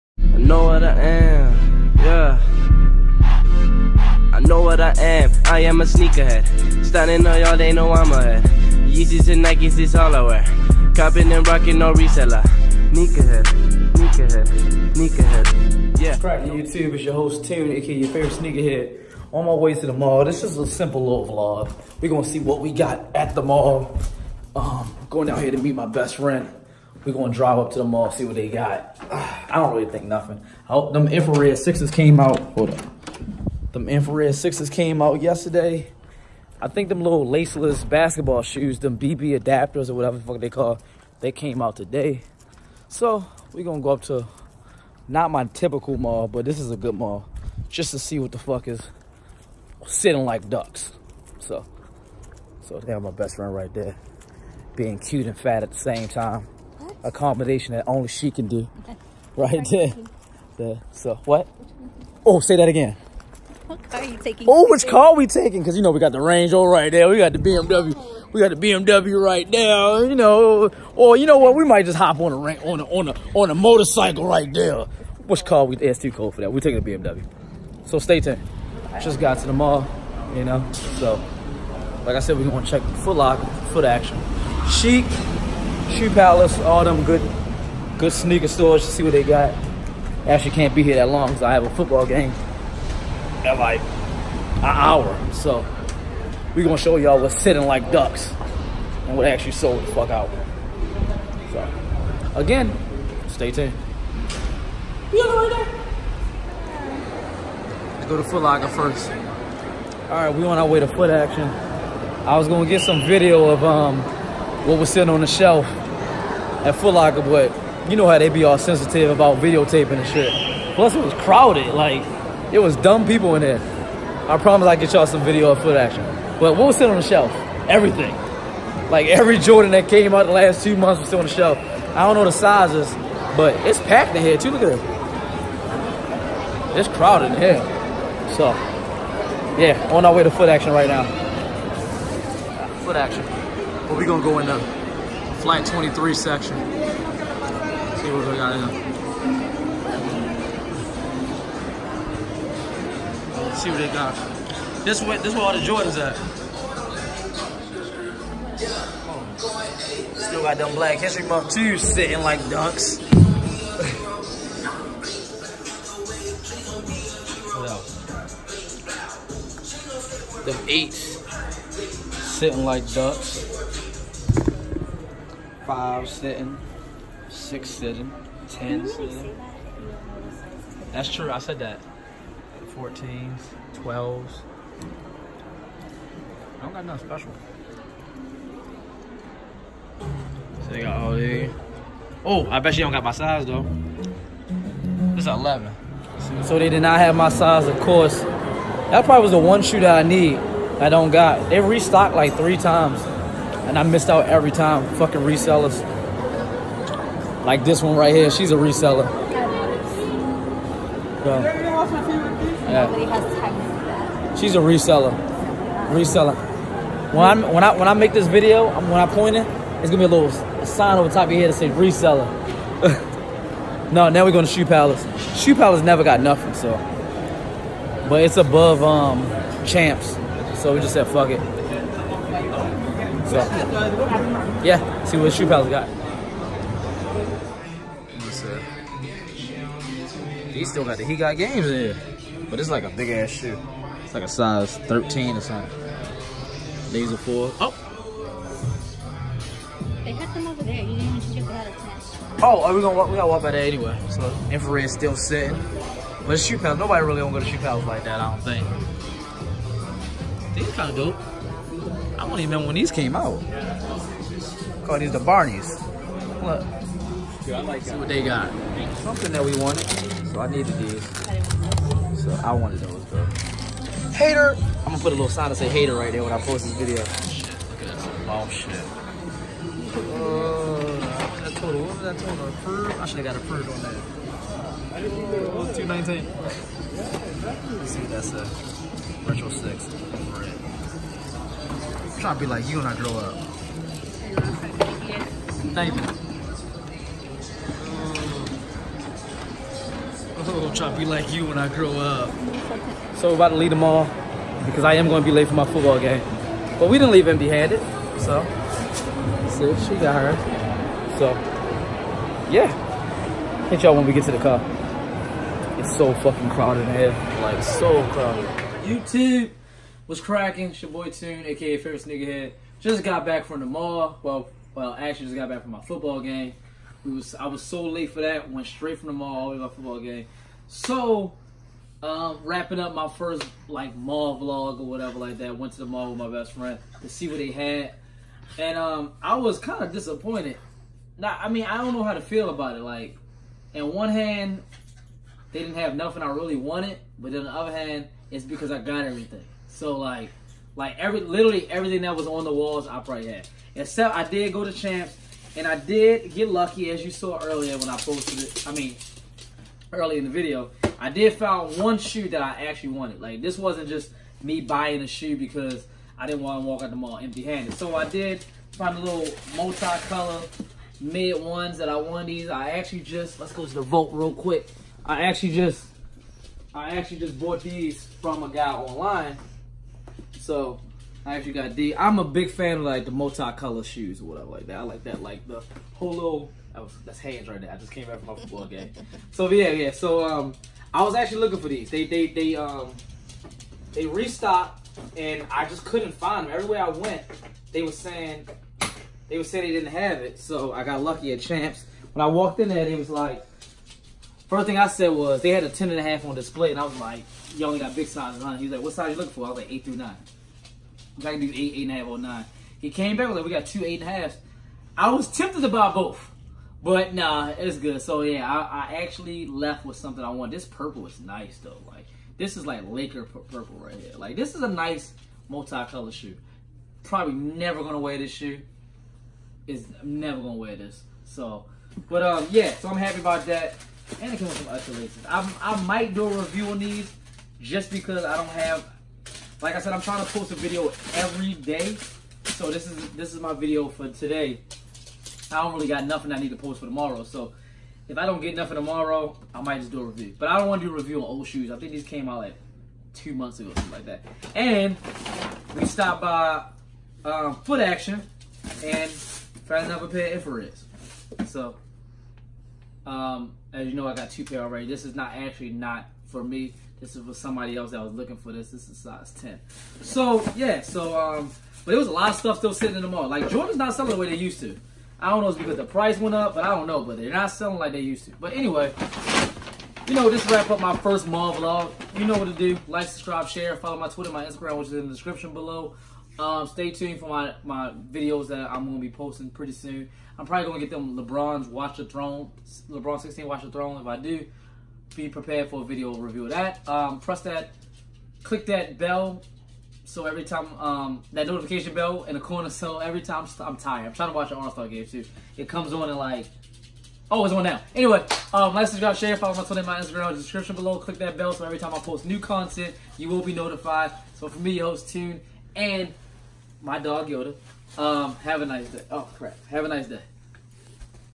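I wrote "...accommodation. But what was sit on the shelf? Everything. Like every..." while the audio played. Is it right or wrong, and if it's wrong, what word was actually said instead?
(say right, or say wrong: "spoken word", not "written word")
wrong: "action", not "accommodation".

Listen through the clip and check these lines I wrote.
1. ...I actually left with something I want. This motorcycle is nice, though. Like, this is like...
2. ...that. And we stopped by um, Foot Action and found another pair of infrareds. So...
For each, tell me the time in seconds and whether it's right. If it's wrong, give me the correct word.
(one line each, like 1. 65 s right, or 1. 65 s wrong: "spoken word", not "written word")
1. 418 s wrong: "purple", not "motorcycle"
2. 454 s right.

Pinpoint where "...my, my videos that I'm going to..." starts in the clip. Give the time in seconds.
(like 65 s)
487 s.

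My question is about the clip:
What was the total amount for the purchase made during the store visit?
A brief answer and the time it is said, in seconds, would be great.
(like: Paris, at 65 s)
219, at 285 s.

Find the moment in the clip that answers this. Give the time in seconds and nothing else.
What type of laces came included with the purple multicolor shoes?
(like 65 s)
434 s.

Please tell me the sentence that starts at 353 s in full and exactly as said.
Except I did go to champs, and I did get lucky, as you saw earlier when I posted it.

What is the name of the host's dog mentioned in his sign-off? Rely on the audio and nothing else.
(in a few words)
Yoda.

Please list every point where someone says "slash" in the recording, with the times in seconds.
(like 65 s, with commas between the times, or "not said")
not said.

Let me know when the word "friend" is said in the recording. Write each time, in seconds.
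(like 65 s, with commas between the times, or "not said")
26 s, 53 s, 336 s.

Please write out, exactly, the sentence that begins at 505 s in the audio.
It comes on and like, Oh, it's on now.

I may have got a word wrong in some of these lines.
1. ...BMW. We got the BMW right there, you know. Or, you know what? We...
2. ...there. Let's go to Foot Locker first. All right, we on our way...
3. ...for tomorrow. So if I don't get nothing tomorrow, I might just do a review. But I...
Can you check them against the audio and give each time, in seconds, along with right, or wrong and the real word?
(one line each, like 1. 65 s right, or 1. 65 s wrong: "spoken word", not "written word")
1. 67 s right
2. 105 s right
3. 446 s right.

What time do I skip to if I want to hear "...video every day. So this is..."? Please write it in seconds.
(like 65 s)
440 s.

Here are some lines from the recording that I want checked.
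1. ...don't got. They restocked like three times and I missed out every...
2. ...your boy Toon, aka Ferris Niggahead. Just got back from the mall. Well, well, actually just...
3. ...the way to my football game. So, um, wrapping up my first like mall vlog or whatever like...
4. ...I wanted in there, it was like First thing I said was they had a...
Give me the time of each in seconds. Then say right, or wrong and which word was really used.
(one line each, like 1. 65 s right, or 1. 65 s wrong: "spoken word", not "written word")
1. 200 s right
2. 320 s right
3. 329 s right
4. 402 s wrong: "walked", not "wanted".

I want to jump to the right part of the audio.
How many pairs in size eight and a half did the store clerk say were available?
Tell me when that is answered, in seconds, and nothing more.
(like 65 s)
413 s.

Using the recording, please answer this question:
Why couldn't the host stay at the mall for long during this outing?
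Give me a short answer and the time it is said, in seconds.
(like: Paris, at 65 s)
A football game, at 91 s.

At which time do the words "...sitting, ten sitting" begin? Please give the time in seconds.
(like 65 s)
177 s.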